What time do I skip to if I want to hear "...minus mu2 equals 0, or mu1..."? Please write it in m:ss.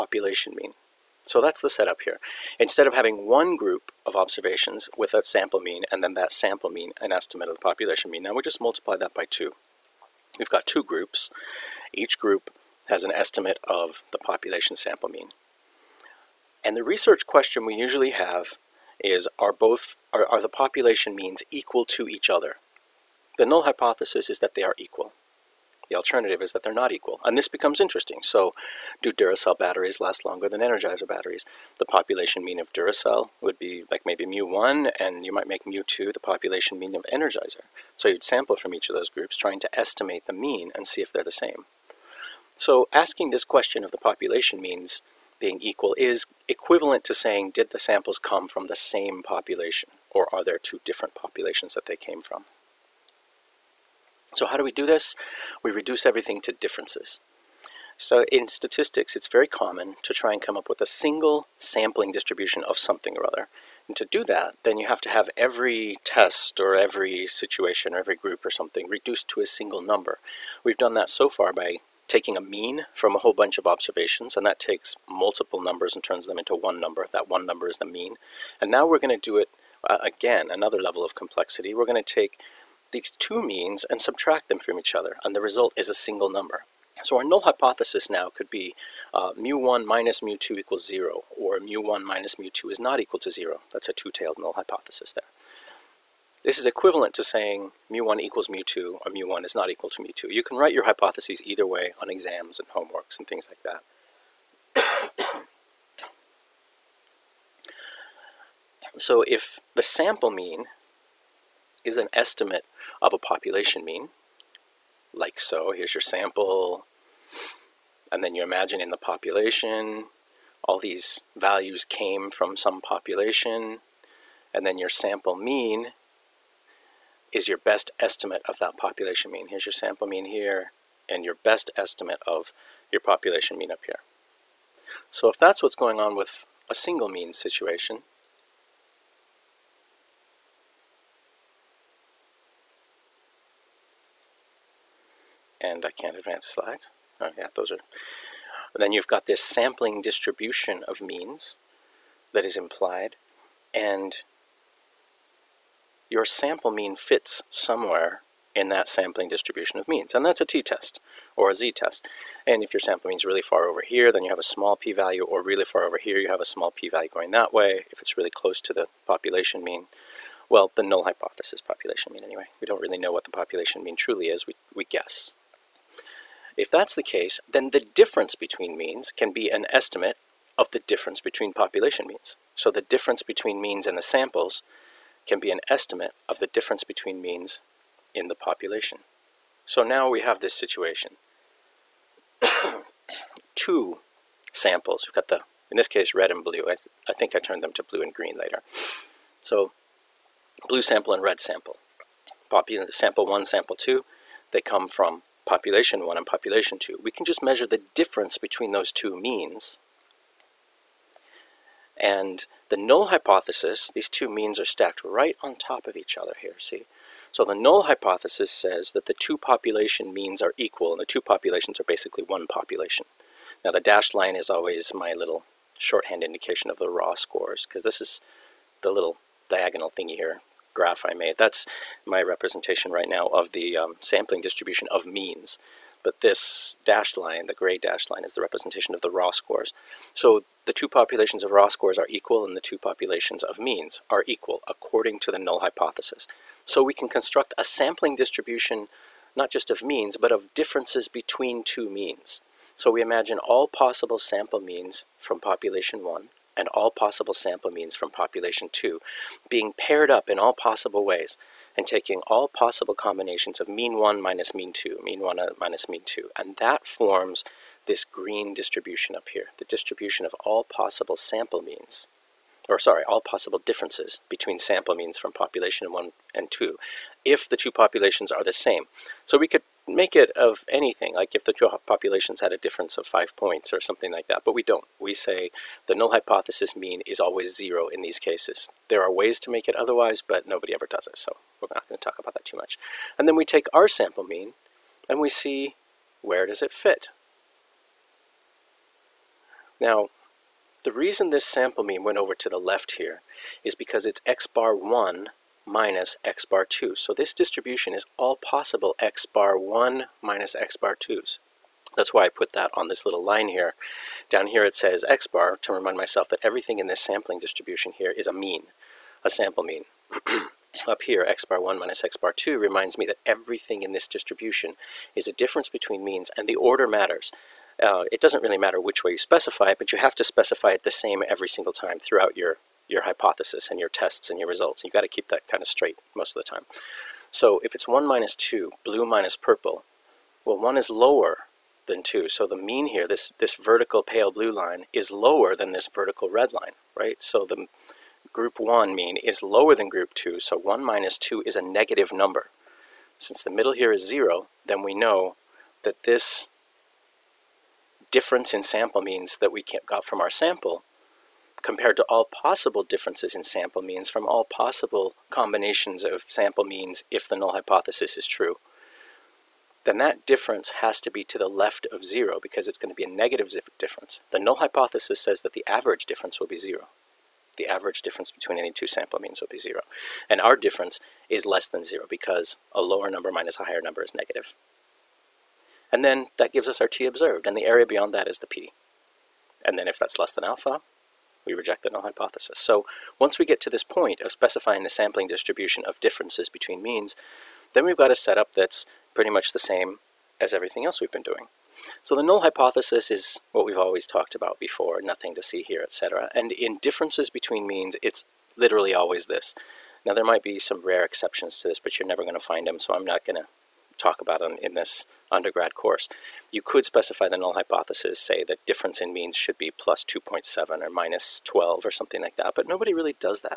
1:29.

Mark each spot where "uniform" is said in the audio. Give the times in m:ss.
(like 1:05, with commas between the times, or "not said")
not said.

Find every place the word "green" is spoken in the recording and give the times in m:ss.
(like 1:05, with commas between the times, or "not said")
3:18, 4:28.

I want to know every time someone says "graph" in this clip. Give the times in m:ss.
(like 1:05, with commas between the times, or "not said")
3:50.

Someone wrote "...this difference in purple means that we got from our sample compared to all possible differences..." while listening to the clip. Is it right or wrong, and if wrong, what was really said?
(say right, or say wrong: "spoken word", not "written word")
wrong: "sample", not "purple".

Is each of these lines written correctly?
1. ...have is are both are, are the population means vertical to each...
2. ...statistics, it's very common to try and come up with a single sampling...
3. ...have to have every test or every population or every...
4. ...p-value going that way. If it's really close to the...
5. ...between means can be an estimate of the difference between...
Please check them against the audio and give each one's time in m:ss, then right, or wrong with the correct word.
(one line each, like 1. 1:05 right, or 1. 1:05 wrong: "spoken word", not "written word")
1. 0:18 wrong: "equal", not "vertical"
2. 0:58 right
3. 1:04 wrong: "situation", not "population"
4. 2:46 right
5. 2:58 right.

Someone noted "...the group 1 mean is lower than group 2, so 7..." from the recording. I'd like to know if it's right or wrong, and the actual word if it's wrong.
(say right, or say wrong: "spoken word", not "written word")
wrong: "1", not "7".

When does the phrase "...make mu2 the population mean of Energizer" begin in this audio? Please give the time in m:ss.
0:35.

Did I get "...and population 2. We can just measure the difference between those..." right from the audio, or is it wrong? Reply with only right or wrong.
right.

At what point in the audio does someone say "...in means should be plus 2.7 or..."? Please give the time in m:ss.
6:59.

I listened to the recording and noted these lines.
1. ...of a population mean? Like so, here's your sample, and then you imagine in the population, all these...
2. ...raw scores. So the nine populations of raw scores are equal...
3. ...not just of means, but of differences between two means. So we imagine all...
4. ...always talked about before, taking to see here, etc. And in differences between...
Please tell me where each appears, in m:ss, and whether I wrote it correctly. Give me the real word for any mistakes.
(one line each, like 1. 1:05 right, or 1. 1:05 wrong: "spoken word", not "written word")
1. 1:53 right
2. 3:59 wrong: "two", not "nine"
3. 4:09 right
4. 6:43 wrong: "nothing", not "taking".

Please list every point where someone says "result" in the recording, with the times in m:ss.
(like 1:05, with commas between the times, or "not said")
1:25, 5:34.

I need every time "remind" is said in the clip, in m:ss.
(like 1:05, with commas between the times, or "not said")
5:15, 5:22.